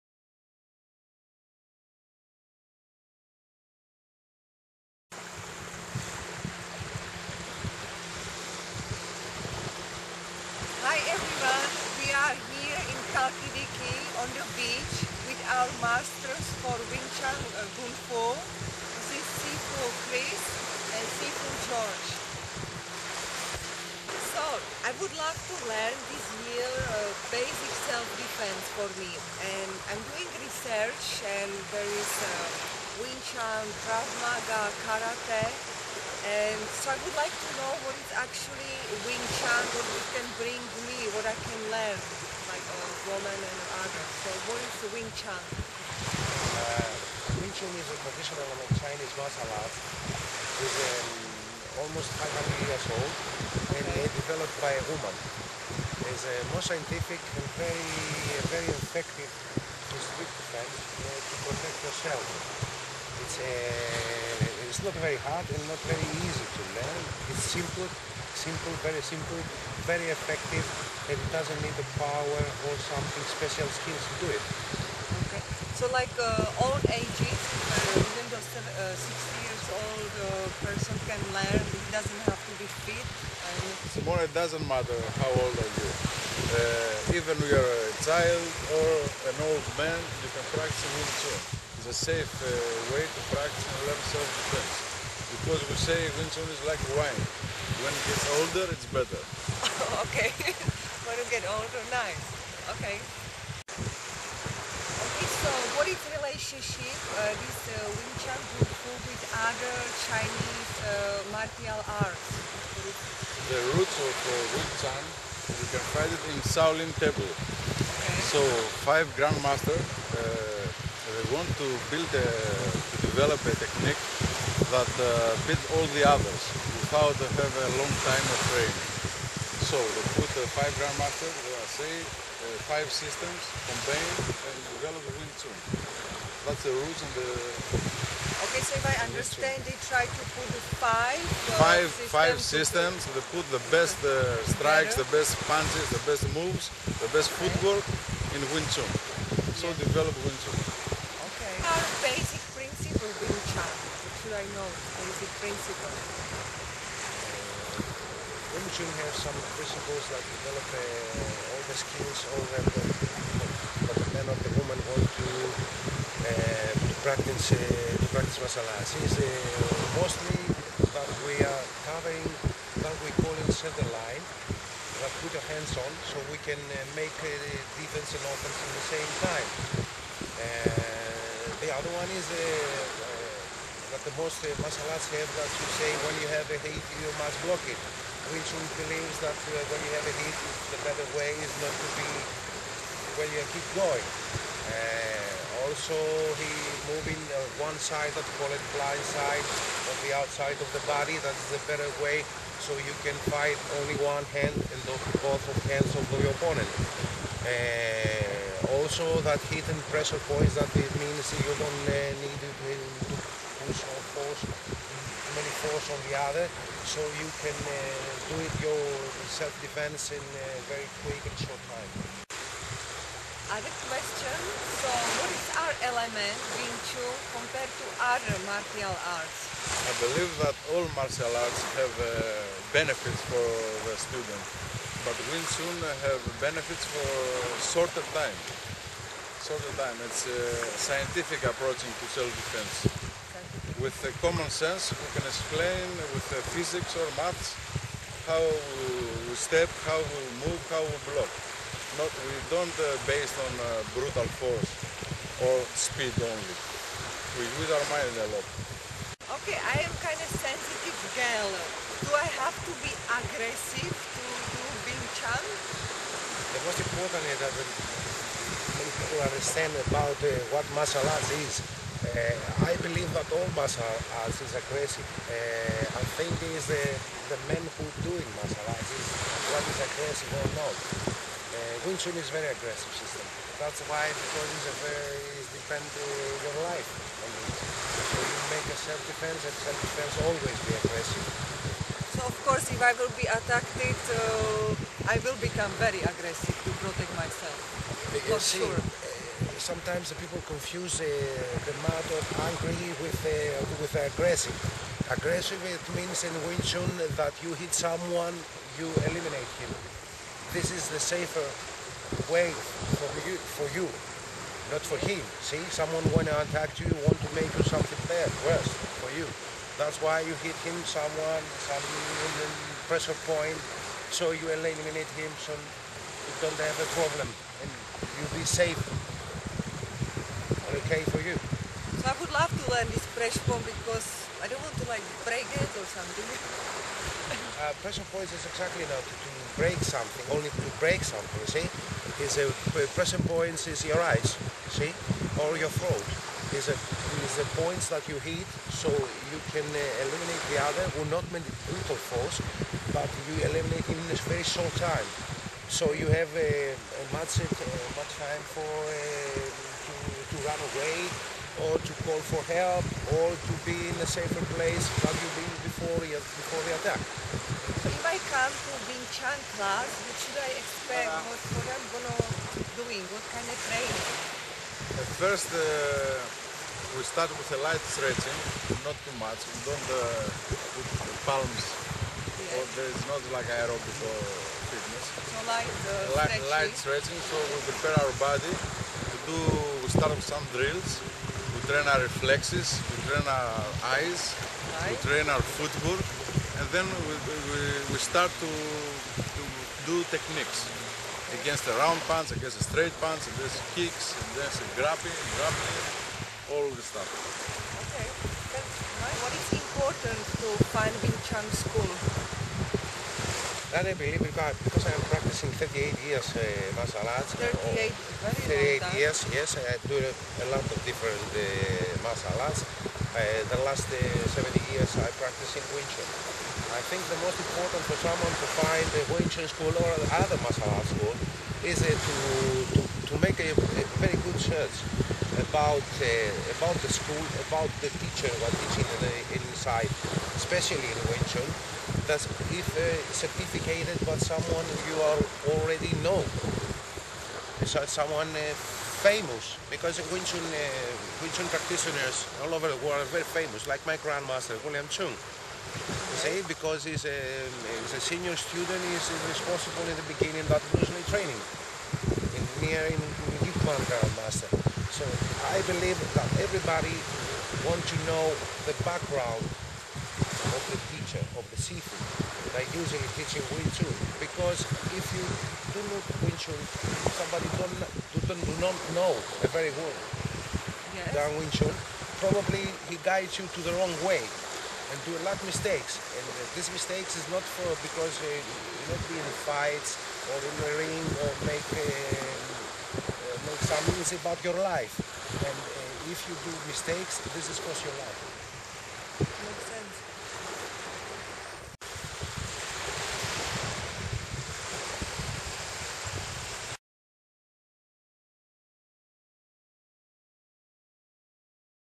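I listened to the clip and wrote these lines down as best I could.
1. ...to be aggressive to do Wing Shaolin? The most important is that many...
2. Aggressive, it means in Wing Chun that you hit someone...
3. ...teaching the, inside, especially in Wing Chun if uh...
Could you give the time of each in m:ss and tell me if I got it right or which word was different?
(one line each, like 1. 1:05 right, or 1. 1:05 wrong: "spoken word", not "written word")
1. 4:22 wrong: "Chun", not "Shaolin"
2. 5:05 right
3. 7:18 right.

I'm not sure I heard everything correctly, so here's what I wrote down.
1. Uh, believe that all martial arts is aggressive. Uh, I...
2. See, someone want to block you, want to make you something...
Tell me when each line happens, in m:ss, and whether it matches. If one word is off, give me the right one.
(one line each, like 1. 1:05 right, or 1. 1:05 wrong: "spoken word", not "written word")
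1. 4:32 right
2. 5:15 wrong: "attack", not "block".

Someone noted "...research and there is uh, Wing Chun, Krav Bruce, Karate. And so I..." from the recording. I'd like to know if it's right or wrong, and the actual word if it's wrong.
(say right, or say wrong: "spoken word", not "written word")
wrong: "Maga", not "Bruce".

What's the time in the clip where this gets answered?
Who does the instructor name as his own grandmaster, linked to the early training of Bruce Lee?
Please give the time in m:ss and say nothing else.
7:34.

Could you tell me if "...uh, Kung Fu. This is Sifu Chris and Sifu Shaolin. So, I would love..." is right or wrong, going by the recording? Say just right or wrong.
wrong.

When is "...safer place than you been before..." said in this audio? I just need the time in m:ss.
6:04.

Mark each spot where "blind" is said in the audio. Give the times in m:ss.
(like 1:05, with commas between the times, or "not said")
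3:18.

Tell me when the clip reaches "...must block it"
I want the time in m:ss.
3:07.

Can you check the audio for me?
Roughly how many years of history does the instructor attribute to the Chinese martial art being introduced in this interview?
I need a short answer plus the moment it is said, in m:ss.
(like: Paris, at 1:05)
500, at 0:51.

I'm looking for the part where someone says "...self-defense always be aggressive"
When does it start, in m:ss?
4:49.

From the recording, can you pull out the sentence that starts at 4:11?
Not, we don't uh, based on uh, brutal force or speed only.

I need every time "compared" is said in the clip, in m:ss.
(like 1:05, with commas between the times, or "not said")
3:47.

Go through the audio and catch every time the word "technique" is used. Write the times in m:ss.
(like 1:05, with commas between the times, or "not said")
2:03, 6:40.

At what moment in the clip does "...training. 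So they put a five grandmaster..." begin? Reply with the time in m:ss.
2:08.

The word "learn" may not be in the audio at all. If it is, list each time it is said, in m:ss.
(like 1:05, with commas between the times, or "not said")
0:25, 0:41, 1:06, 1:21, 1:33, 5:32.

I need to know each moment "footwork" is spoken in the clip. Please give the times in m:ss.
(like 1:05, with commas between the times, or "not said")
2:27, 6:35.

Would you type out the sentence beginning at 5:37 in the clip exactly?
uh, pressure point is exactly not to, to break something, only to break something, see?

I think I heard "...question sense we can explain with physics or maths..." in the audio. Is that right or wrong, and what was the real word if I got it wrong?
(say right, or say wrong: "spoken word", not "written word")
wrong: "common", not "question".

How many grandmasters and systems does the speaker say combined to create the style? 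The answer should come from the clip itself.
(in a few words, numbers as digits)
5.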